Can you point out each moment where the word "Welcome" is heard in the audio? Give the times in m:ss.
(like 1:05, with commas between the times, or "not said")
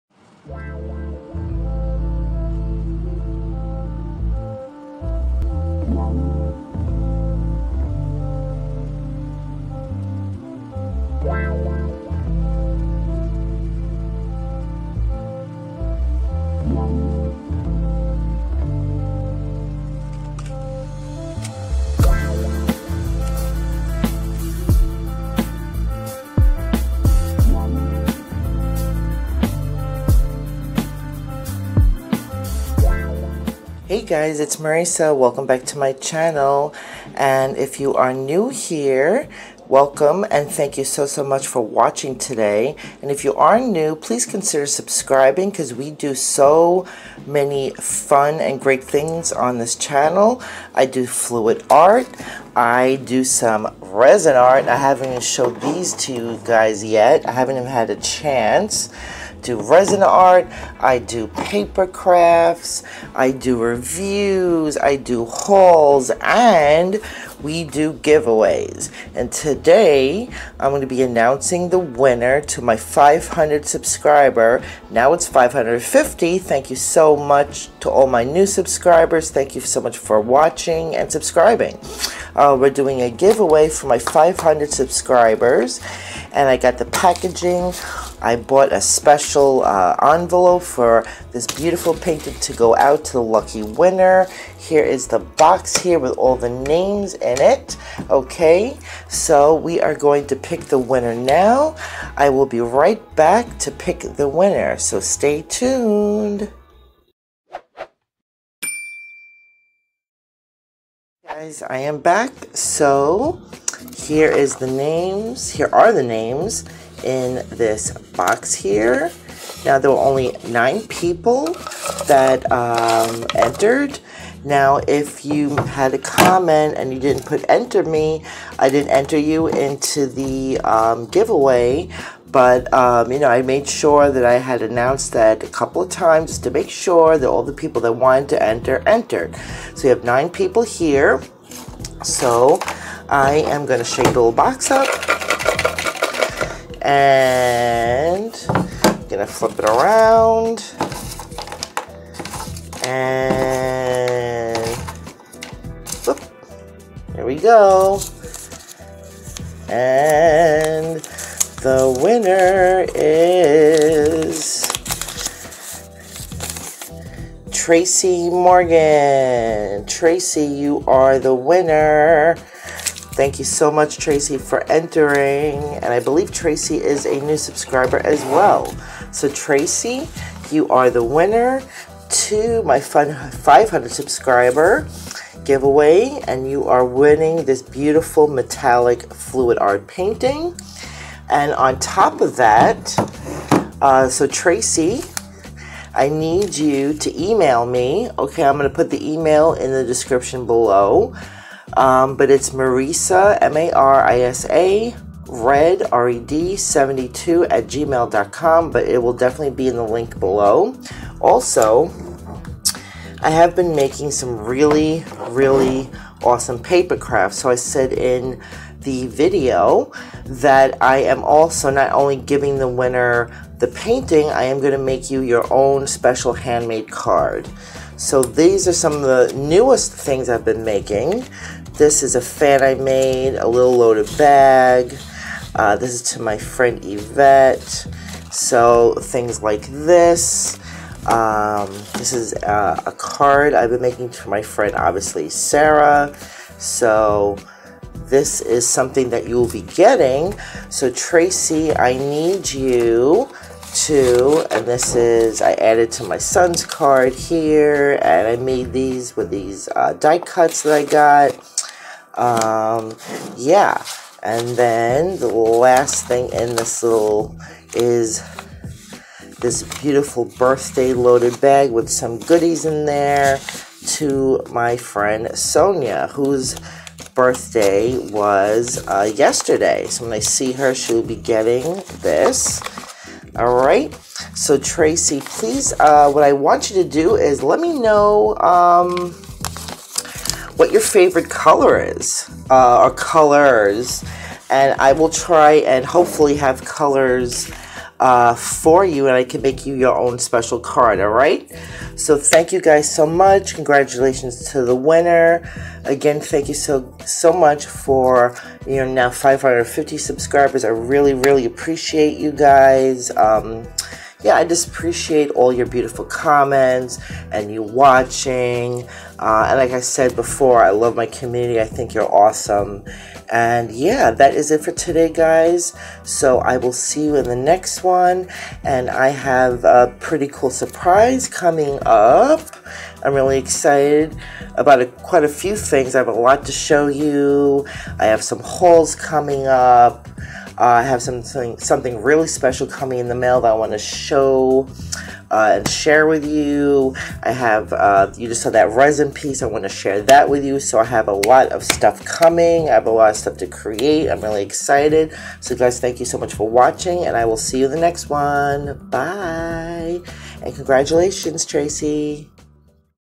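0:35, 0:39.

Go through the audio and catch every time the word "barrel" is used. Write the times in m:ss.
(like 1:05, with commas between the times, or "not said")
not said.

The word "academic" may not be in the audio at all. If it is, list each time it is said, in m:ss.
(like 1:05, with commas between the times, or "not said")
not said.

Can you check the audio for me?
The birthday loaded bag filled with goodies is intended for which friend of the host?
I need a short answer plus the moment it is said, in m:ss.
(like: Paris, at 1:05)
Sonia, at 4:35.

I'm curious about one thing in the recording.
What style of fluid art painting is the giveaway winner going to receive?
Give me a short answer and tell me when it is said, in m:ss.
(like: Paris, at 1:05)
Metallic, at 3:08.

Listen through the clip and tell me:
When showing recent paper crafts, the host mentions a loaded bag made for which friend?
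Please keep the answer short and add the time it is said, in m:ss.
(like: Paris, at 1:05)
Yvette, at 3:56.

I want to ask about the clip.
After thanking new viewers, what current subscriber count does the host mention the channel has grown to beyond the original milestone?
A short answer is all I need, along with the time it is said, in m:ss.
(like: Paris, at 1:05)
550, at 1:14.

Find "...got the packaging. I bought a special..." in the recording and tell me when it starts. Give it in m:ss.
1:26.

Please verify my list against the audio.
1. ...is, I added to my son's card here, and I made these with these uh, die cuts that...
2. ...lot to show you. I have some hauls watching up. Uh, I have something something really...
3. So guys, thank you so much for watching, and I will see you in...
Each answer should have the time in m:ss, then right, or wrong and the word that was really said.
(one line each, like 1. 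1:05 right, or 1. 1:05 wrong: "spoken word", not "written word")
1. 4:14 right
2. 5:36 wrong: "coming", not "watching"
3. 5:55 right.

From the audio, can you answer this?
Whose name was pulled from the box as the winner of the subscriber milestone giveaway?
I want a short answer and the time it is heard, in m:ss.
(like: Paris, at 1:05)
Tracy Morgan, at 2:47.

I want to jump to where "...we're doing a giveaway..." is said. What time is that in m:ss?
1:22.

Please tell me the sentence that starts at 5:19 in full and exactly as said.
Uh, and like I said before, I love my community.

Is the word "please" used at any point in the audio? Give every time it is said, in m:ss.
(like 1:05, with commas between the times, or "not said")
0:43, 4:45.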